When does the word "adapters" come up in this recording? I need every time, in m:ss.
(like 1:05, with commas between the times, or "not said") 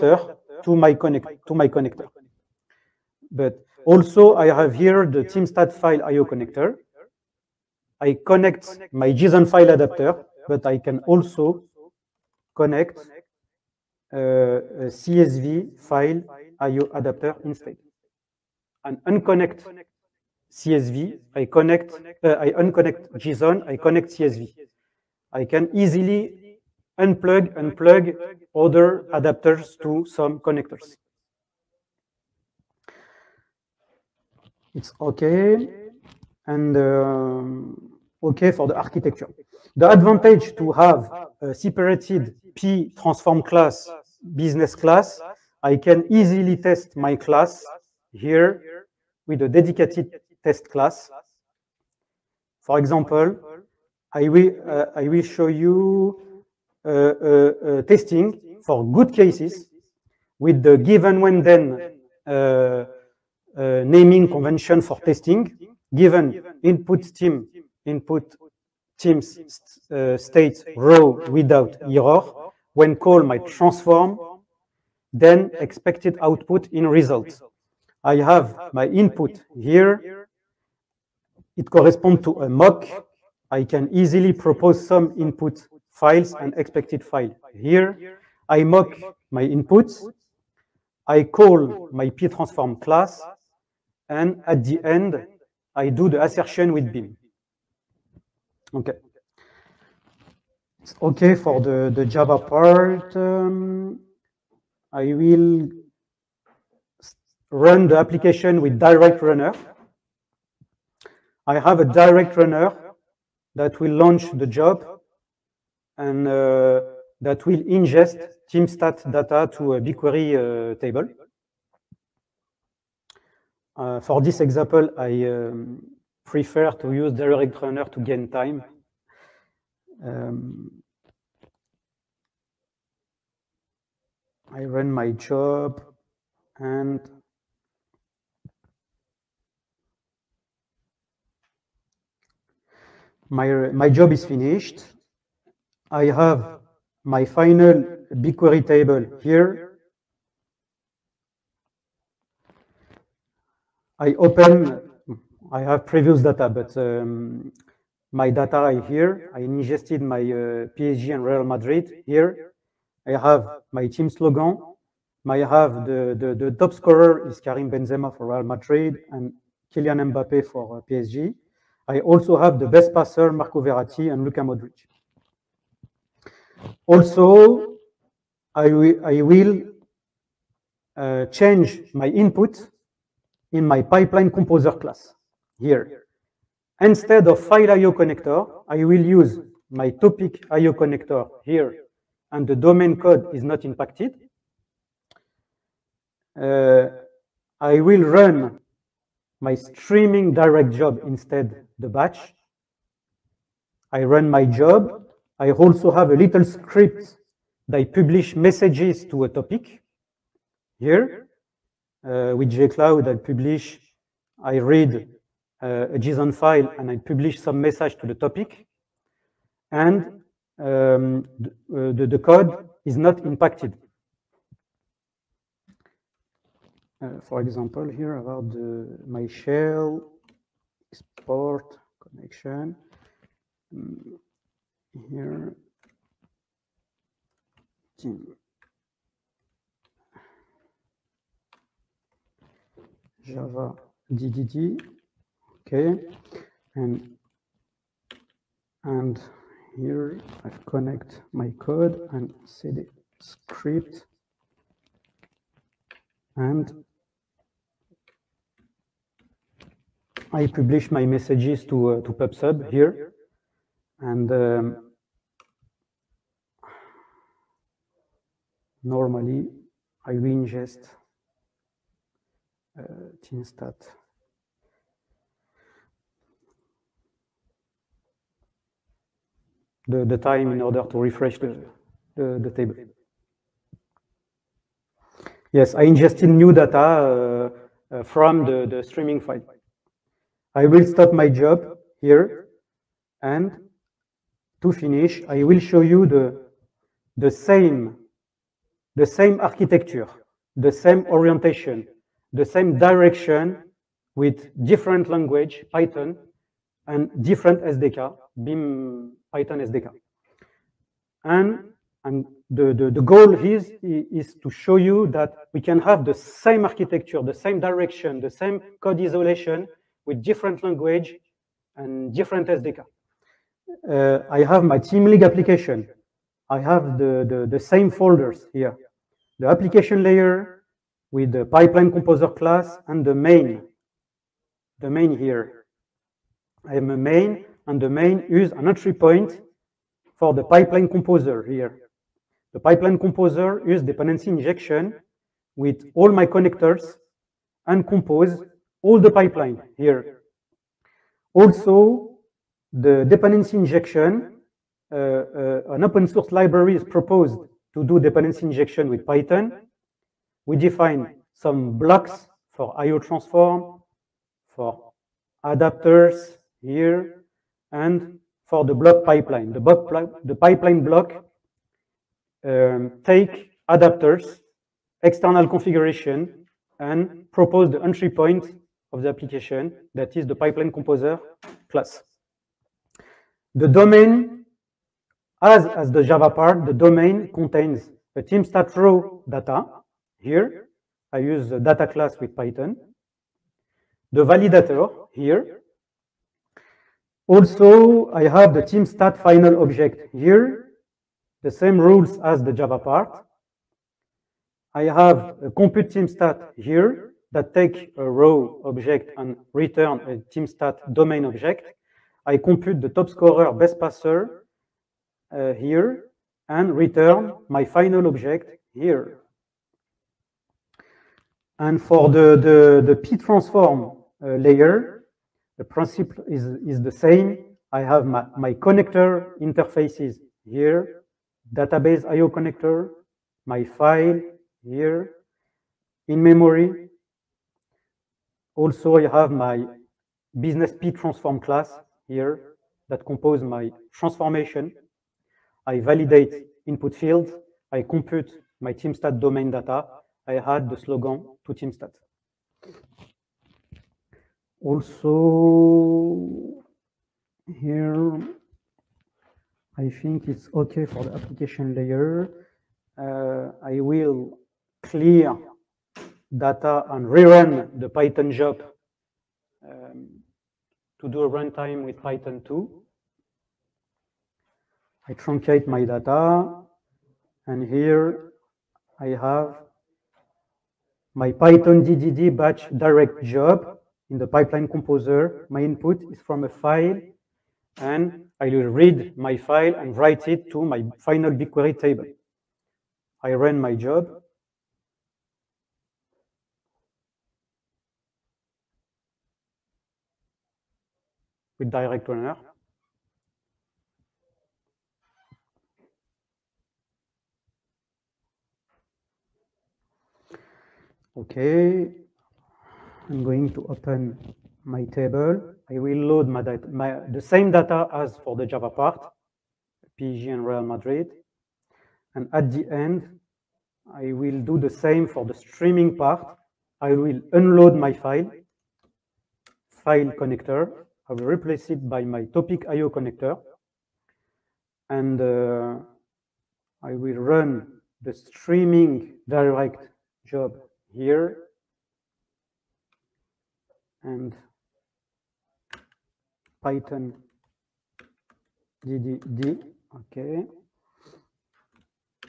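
0:09, 0:16, 0:29, 6:05, 6:13.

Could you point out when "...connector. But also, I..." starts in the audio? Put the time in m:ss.
0:01.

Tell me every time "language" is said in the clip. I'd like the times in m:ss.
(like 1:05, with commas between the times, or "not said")
5:05, 5:20.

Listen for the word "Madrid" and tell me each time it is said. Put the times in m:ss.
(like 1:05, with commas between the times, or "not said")
2:41, 2:48, 8:40.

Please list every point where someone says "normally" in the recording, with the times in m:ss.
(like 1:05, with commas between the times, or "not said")
4:28.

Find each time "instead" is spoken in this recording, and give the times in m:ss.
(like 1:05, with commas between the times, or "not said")
0:17, 3:06, 3:21.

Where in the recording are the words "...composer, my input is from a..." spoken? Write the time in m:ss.
8:04.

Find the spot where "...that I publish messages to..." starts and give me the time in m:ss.
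3:27.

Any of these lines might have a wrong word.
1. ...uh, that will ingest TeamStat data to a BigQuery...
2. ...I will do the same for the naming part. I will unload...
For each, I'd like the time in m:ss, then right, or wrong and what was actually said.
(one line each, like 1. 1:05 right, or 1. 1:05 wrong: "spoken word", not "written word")
1. 1:56 right
2. 8:43 wrong: "streaming", not "naming".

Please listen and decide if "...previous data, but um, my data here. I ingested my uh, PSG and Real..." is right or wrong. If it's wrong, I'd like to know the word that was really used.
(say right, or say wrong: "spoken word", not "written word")
right.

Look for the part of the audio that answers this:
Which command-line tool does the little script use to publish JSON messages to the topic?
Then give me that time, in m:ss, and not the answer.
3:32.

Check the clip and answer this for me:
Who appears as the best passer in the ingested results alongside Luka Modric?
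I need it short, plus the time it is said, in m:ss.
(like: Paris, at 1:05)
Marco Verratti, at 2:53.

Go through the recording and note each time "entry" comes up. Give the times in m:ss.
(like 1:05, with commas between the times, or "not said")
5:38, 6:17.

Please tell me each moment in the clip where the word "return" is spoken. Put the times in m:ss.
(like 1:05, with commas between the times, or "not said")
6:49, 6:56.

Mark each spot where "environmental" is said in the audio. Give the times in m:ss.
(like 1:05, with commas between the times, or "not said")
not said.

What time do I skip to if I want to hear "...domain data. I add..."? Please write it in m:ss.
7:29.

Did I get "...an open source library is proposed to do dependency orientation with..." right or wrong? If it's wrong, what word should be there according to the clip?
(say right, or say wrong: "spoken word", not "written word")
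wrong: "injection", not "orientation".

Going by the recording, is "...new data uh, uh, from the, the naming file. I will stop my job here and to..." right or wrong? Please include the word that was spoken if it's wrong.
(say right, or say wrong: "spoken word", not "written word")
wrong: "streaming", not "naming".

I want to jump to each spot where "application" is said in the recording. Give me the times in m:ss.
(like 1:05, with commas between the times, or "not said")
1:47, 5:25, 5:29, 6:19, 7:41.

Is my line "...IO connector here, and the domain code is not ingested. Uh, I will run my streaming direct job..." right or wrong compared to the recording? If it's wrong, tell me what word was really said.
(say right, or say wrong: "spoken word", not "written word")
wrong: "impacted", not "ingested".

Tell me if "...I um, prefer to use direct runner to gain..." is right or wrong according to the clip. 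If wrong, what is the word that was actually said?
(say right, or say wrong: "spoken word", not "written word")
right.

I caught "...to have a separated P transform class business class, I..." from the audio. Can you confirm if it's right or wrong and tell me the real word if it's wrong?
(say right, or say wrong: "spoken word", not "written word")
right.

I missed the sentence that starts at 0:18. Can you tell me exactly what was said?
And unconnect CSV, I connect, uh, I unconnect JSON, I connect CSV.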